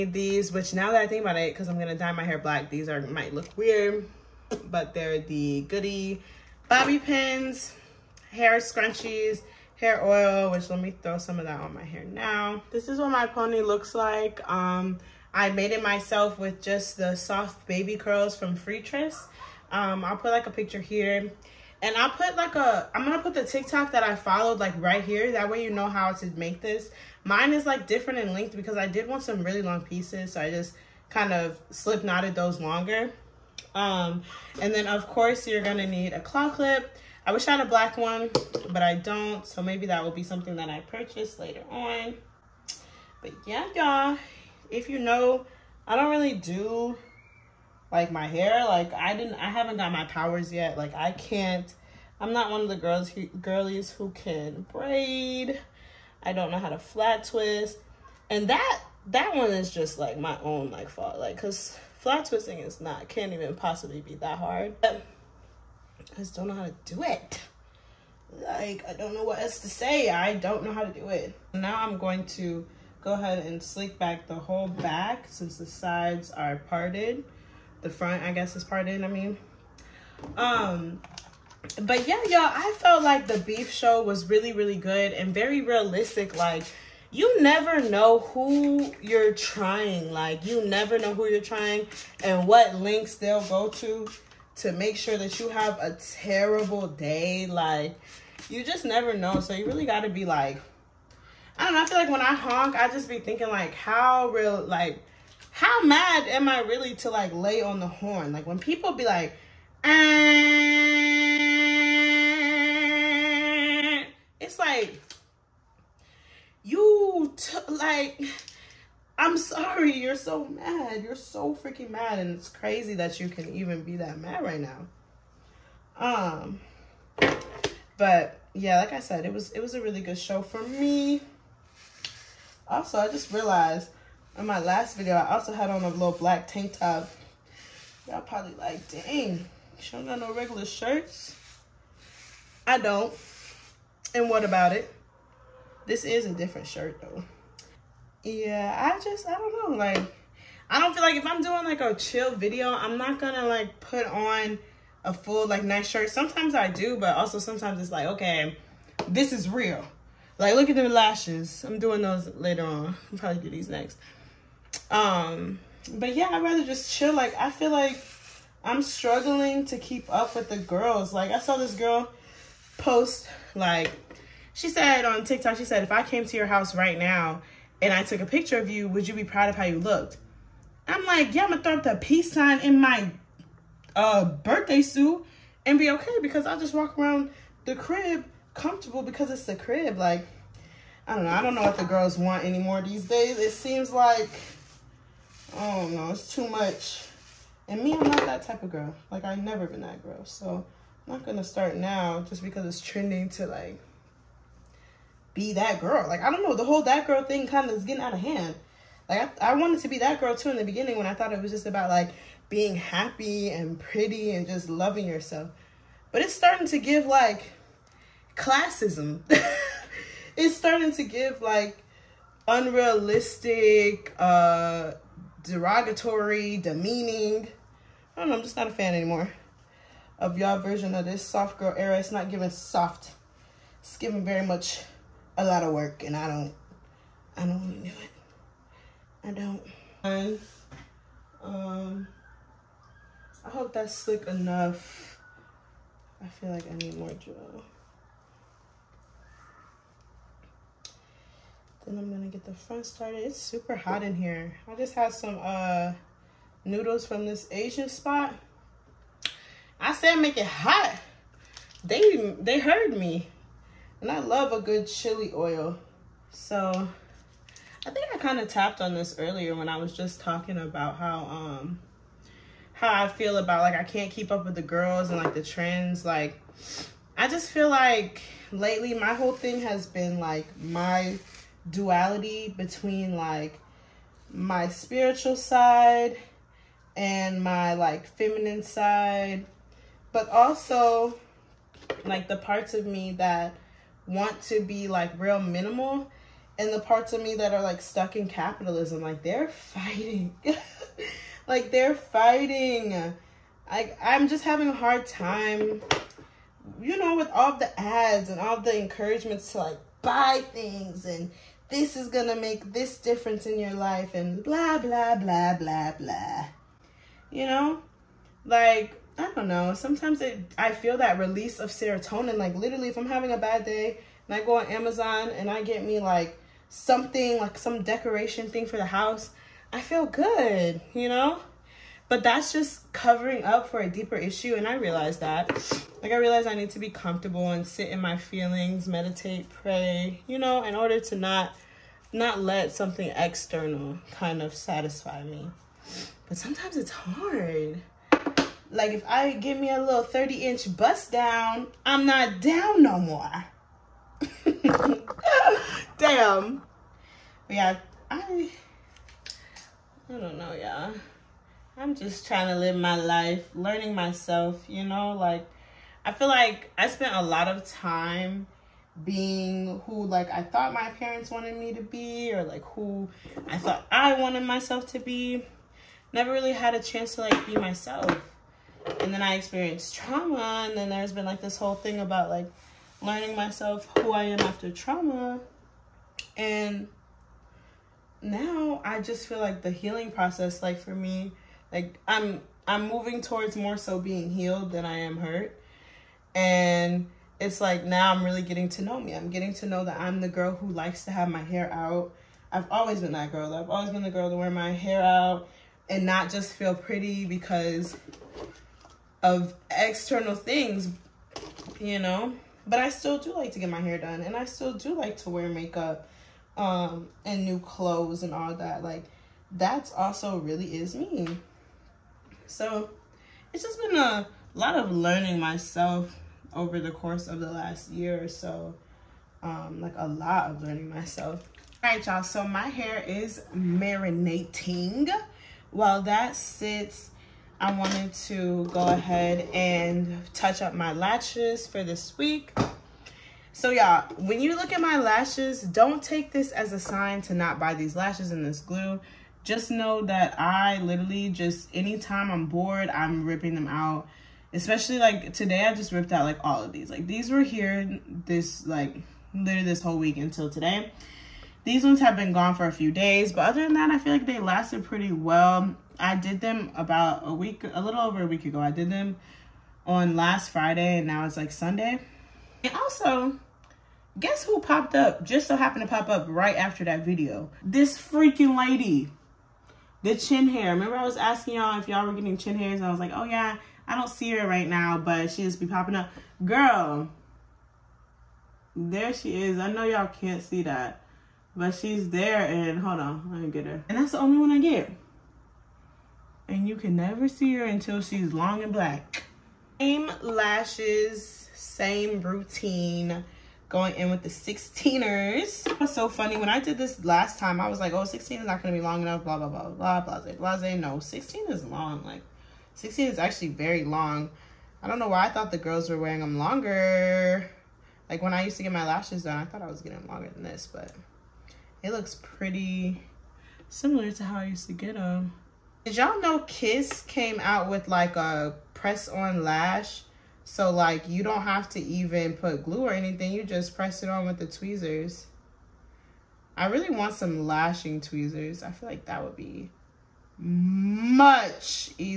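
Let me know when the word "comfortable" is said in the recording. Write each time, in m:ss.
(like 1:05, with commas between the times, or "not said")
3:08, 5:36.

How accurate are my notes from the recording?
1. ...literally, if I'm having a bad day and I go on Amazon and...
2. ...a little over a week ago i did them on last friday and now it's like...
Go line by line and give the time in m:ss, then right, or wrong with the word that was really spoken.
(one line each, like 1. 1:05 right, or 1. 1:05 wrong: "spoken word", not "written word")
1. 5:22 right
2. 7:47 right.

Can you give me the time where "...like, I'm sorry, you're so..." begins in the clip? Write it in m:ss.
1:57.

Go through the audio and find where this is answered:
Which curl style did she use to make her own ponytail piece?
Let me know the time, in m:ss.
0:17.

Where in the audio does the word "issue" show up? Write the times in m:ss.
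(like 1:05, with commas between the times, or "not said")
5:34.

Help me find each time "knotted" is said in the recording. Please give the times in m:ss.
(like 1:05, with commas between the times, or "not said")
0:32.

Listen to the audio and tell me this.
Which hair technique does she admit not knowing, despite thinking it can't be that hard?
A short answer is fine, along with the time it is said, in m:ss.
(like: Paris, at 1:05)
flat twist, at 0:56.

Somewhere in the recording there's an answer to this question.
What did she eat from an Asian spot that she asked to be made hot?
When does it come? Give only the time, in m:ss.
4:16.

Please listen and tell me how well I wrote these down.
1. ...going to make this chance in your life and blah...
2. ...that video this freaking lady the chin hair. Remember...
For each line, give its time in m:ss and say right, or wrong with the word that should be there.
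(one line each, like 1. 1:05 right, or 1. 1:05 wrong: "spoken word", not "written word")
1. 5:12 wrong: "difference", not "chance"
2. 7:56 right.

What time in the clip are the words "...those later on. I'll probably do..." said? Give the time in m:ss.
2:42.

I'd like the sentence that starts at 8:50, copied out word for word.
So like you don't have to even put glue or anything.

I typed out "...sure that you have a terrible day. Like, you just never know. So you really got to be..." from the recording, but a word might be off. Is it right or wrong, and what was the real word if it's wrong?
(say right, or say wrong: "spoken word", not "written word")
right.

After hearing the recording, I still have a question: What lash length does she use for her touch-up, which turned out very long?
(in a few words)
16.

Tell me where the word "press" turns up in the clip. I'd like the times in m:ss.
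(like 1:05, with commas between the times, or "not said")
8:48, 8:53.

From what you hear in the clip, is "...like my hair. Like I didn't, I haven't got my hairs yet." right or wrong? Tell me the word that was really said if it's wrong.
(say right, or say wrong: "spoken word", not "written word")
wrong: "powers", not "hairs".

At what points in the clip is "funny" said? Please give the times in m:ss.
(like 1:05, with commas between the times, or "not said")
8:26.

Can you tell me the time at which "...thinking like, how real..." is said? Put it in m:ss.
1:43.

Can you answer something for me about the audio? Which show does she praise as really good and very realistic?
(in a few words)
Beef.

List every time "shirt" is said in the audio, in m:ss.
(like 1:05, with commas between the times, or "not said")
2:20, 2:26, 2:35.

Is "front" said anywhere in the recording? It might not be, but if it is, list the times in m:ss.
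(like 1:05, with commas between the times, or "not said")
1:17, 4:12.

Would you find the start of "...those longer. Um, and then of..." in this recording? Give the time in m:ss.
0:32.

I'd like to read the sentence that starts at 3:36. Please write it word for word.
But it's starting to give, like, classism.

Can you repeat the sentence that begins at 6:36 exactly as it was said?
And it's like now I'm really getting to know me.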